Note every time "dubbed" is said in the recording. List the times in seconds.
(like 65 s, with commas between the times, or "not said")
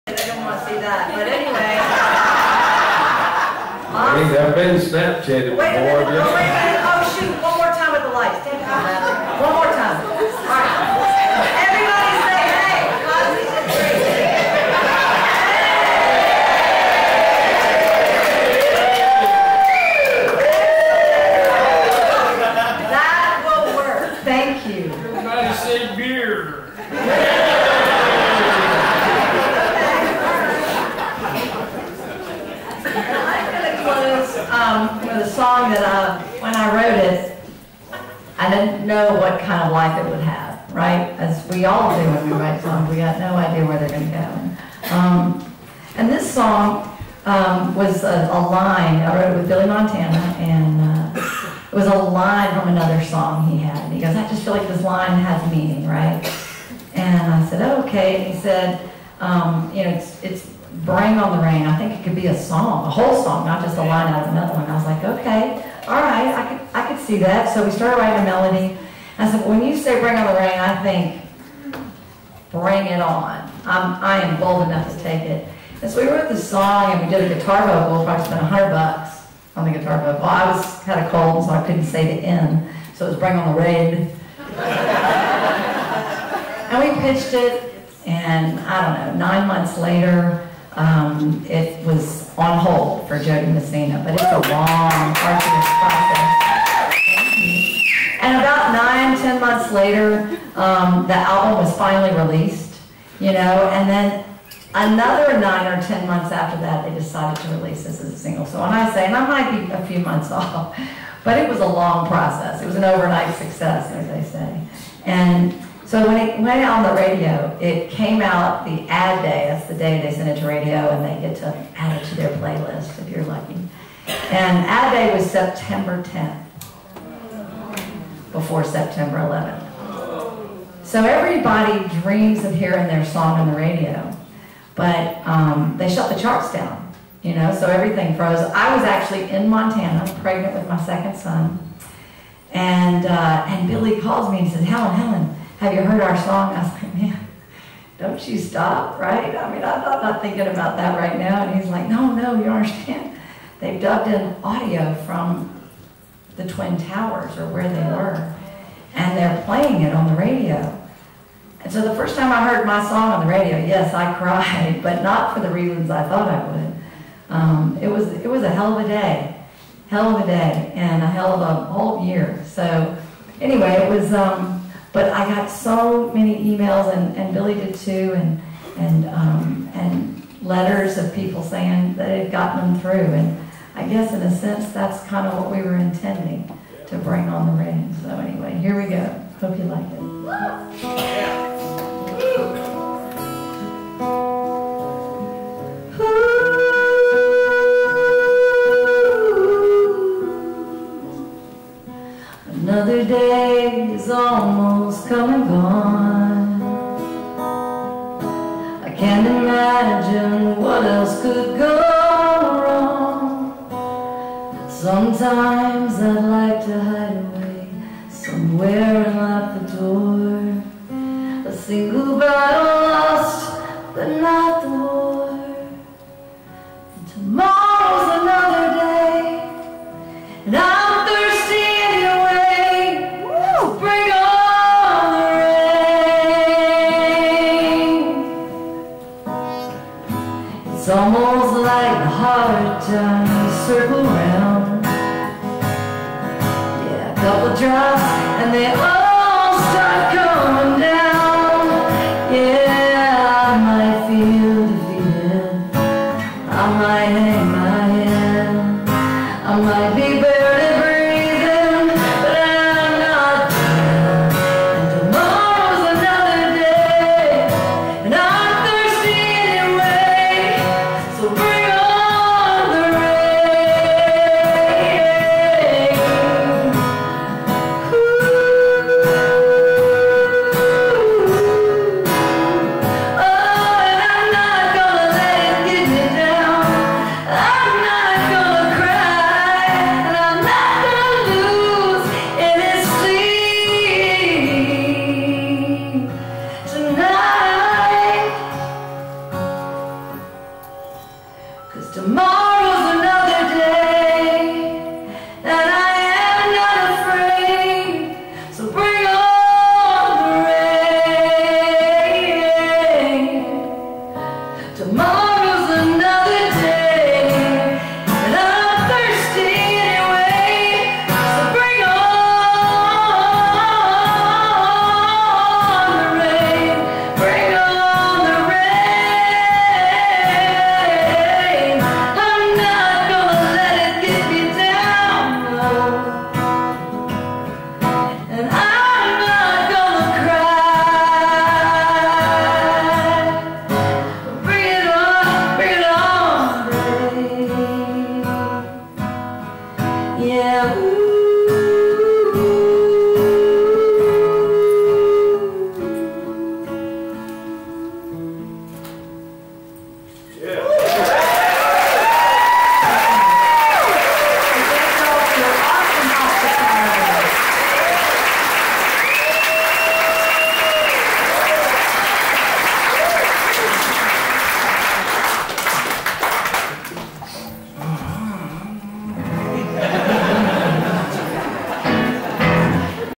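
153 s.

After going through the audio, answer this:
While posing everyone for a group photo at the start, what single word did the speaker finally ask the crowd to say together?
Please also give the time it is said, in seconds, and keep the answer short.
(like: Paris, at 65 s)
beer, at 25 s.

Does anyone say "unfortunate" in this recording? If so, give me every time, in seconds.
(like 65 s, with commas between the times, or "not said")
not said.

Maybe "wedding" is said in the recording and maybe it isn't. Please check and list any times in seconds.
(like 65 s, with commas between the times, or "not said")
not said.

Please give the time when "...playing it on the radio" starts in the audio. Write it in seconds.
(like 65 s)
159 s.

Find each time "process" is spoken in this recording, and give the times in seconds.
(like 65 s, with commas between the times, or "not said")
95 s, 112 s.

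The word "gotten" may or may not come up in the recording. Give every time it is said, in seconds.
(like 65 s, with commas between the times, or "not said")
182 s.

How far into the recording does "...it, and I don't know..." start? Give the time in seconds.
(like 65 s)
87 s.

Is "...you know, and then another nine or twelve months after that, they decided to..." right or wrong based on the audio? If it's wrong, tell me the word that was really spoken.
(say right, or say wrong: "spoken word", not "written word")
wrong: "ten", not "twelve".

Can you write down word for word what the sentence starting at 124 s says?
And ad day was September 10th, before September 11th.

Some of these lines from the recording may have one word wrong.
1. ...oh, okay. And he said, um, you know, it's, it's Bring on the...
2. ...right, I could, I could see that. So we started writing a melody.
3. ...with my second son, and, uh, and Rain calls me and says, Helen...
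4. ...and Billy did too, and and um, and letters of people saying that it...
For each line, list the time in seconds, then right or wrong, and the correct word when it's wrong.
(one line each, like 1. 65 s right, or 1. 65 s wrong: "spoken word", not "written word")
1. 57 s right
2. 65 s right
3. 140 s wrong: "Billy", not "Rain"
4. 177 s right.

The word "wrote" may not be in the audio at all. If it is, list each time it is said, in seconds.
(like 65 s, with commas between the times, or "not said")
36 s, 49 s, 76 s.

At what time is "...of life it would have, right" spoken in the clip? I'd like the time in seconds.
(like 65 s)
39 s.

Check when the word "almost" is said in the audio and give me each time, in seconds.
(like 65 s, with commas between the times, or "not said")
204 s, 240 s.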